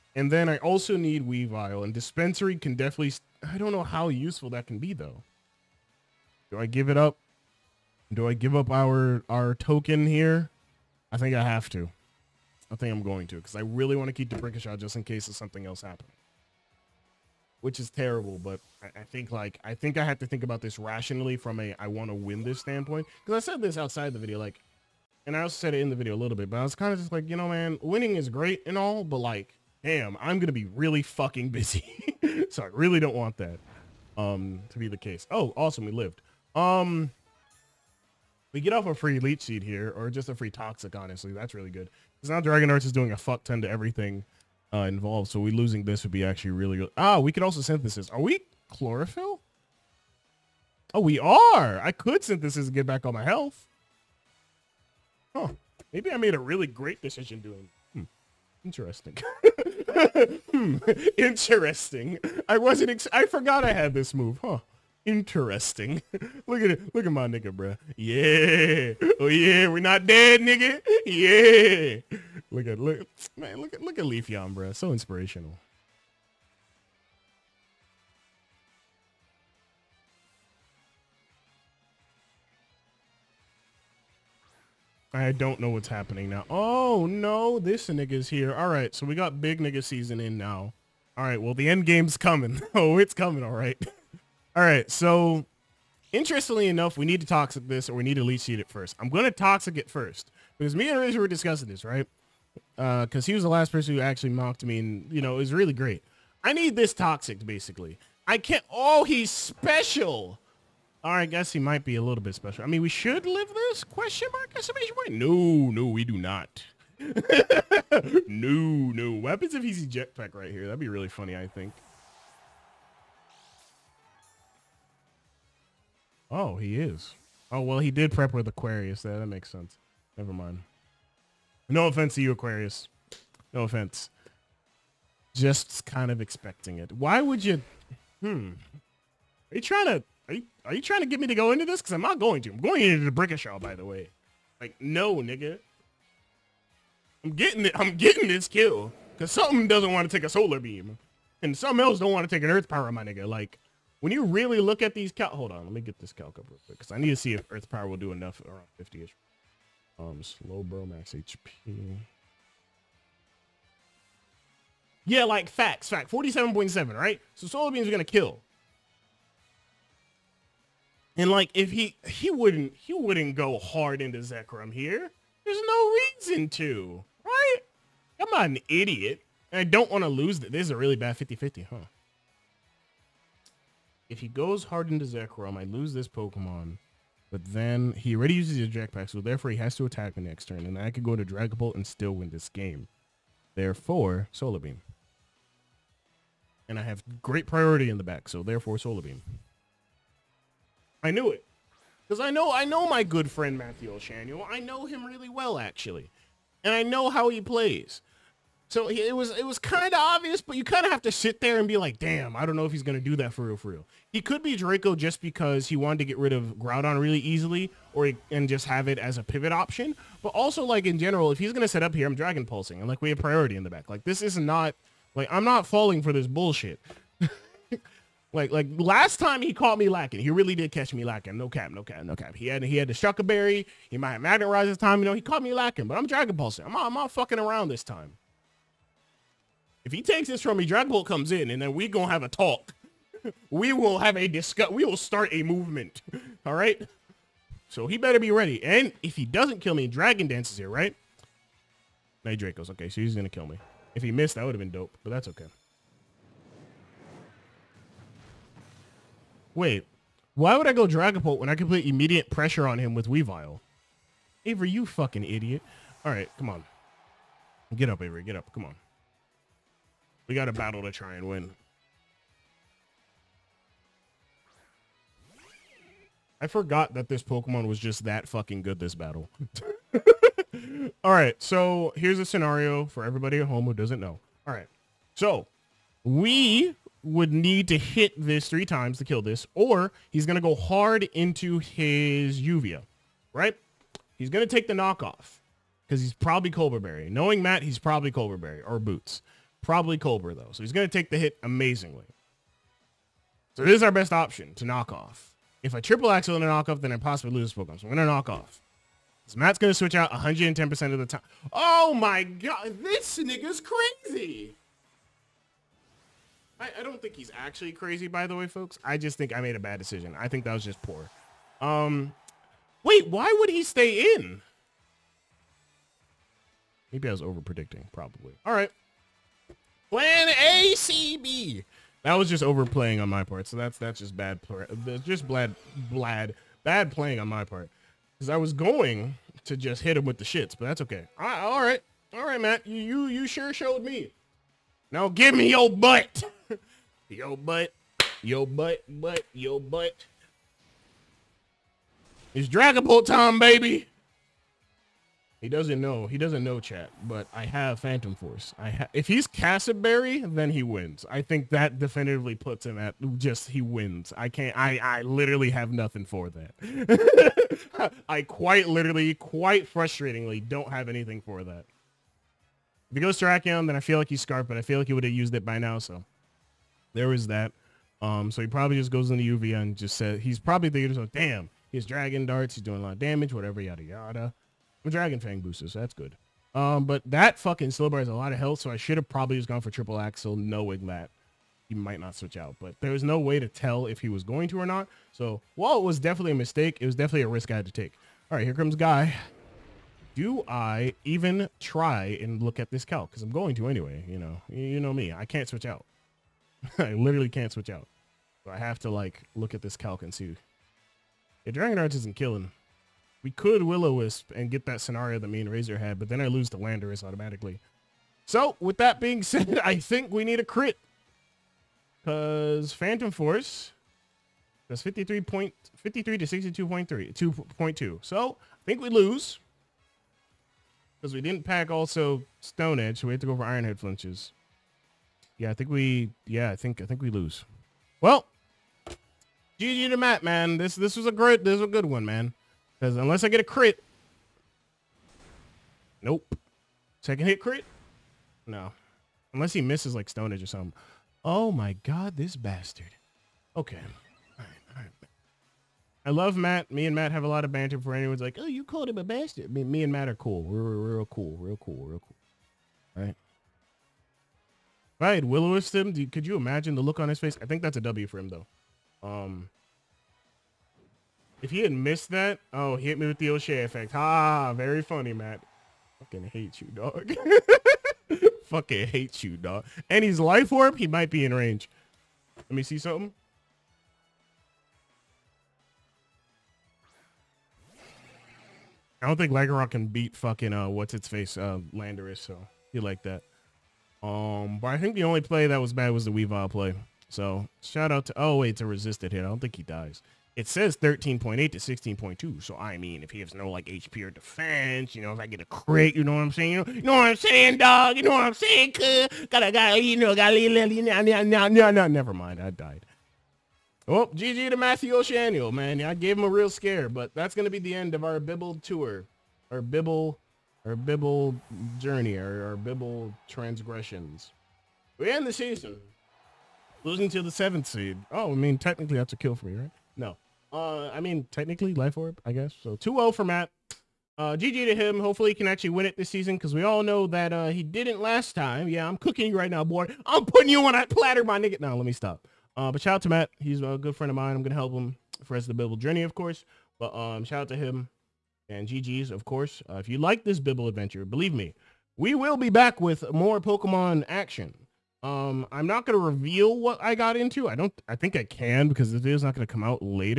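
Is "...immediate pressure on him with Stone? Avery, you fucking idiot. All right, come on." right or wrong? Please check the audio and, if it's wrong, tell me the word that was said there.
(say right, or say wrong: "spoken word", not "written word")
wrong: "Weavile", not "Stone".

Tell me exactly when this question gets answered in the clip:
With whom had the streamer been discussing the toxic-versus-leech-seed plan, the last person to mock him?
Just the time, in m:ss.
1:40.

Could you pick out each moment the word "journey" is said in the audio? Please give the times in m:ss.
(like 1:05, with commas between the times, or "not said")
8:41, 9:05.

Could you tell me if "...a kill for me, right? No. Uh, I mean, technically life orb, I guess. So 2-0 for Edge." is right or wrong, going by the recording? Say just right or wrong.
wrong.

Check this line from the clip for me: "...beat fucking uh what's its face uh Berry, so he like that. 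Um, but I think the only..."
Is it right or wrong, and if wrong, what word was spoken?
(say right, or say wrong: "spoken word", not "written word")
wrong: "Landorus", not "Berry".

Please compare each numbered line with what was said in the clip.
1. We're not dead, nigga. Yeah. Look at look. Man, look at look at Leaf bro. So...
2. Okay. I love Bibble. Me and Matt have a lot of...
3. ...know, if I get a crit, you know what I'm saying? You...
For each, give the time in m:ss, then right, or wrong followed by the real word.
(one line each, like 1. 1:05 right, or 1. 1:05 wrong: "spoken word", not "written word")
1. 1:09 right
2. 7:33 wrong: "Matt", not "Bibble"
3. 8:25 right.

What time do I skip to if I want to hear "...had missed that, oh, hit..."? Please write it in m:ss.
7:51.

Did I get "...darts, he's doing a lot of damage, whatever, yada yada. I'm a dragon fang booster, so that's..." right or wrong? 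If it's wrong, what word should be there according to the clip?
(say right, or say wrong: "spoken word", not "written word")
right.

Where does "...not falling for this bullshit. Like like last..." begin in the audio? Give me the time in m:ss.
3:45.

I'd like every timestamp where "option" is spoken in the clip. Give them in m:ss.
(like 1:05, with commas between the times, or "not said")
3:39, 5:04.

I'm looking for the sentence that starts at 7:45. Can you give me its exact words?
Do, could you imagine the look on his face?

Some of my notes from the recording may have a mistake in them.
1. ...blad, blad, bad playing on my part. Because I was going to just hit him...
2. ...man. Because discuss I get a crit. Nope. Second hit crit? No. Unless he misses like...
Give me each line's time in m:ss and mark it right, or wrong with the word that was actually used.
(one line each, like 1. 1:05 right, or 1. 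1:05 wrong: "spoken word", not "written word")
1. 5:35 right
2. 7:22 wrong: "unless", not "discuss".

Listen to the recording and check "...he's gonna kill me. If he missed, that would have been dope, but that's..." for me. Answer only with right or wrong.
right.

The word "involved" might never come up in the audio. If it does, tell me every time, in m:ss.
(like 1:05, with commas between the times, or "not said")
0:44.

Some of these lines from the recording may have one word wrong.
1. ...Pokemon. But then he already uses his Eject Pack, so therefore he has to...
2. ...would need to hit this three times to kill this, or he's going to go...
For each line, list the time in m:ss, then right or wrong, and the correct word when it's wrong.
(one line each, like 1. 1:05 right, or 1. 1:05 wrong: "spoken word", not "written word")
1. 3:06 right
2. 4:47 right.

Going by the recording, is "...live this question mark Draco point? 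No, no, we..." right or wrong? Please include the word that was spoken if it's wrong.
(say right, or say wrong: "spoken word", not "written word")
wrong: "Estimation", not "Draco".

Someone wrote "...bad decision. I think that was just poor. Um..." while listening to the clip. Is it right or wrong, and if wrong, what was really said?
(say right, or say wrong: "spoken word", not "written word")
right.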